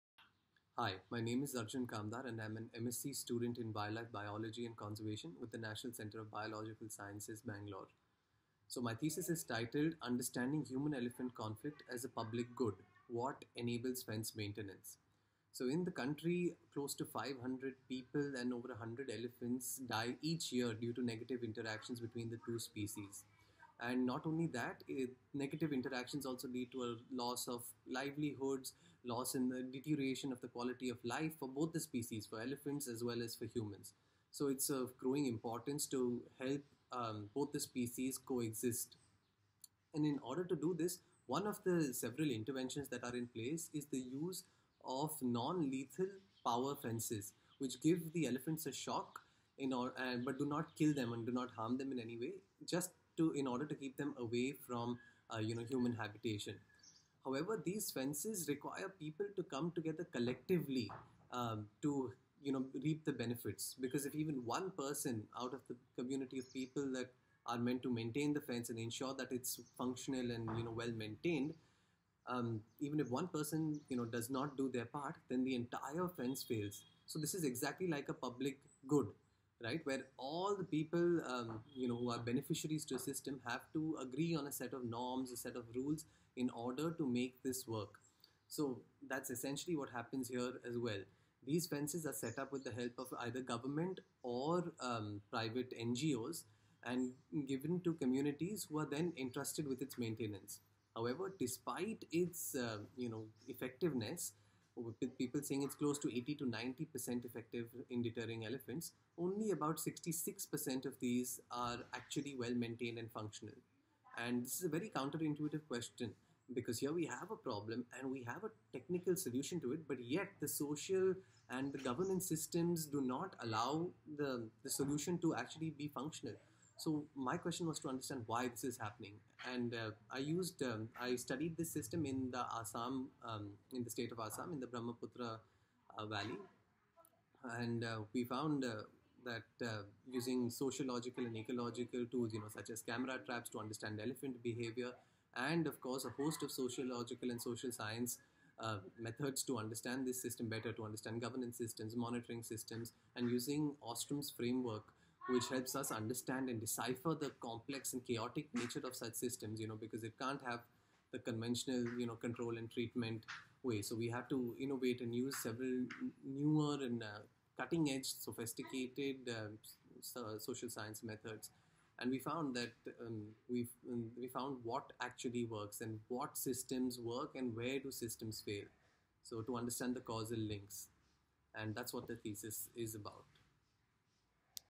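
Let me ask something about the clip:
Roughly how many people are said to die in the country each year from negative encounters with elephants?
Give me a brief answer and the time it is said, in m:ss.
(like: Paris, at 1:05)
500, at 0:17.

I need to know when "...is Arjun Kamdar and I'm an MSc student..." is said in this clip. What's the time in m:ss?
0:01.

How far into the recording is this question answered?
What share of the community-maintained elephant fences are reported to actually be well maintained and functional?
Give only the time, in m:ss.
1:49.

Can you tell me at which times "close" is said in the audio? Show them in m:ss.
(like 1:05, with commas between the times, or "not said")
0:16, 1:45.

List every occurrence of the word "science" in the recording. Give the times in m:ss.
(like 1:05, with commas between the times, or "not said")
0:06, 2:27, 2:50.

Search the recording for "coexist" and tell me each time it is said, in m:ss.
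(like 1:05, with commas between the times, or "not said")
0:38.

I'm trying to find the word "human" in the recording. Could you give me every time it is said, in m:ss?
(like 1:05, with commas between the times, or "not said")
0:10, 0:33, 0:55.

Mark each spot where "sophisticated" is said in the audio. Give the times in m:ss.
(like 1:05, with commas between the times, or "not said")
2:48.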